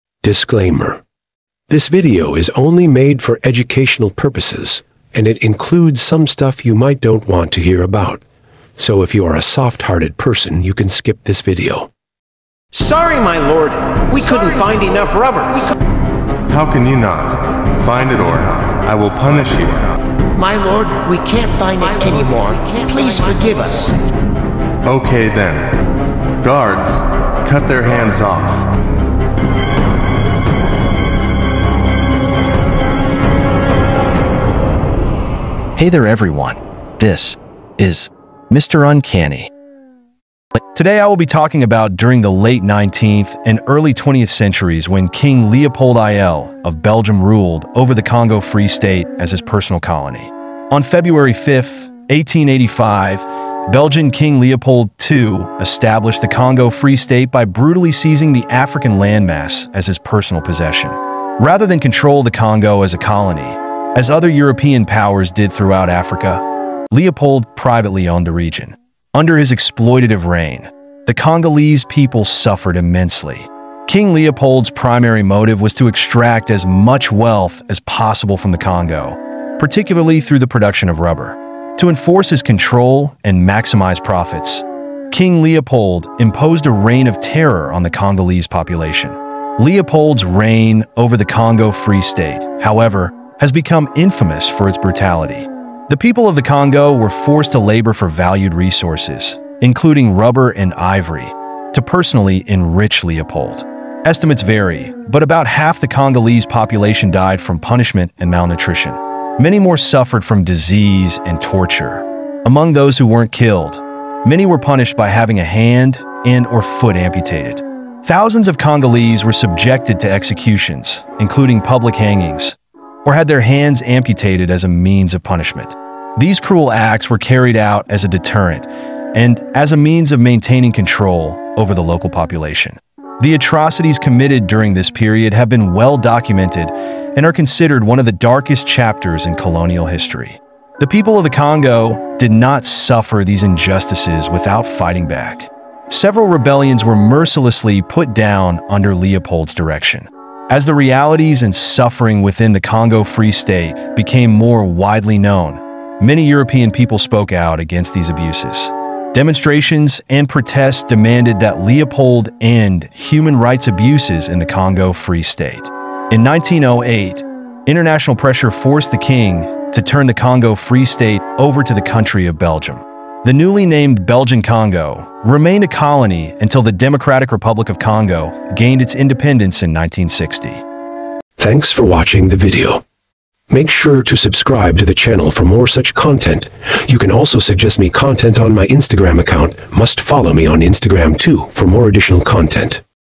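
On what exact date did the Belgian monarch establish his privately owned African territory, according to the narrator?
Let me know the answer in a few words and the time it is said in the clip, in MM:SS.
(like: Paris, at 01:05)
February 5, 1885, at 00:50.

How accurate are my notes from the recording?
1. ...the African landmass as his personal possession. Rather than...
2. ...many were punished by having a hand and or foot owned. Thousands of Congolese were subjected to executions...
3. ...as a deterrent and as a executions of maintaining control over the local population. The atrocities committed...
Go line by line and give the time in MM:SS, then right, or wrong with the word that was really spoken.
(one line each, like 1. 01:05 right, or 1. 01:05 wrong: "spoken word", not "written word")
1. 00:58 right
2. 01:54 wrong: "amputated", not "owned"
3. 02:07 wrong: "means", not "executions".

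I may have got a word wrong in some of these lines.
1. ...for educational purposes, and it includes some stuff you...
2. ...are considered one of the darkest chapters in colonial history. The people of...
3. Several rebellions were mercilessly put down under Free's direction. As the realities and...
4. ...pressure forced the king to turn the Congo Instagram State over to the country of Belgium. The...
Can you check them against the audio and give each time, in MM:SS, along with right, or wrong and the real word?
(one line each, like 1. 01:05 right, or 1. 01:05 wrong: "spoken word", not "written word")
1. 00:03 right
2. 02:17 right
3. 02:25 wrong: "Leopold", not "Free"
4. 02:48 wrong: "Free", not "Instagram".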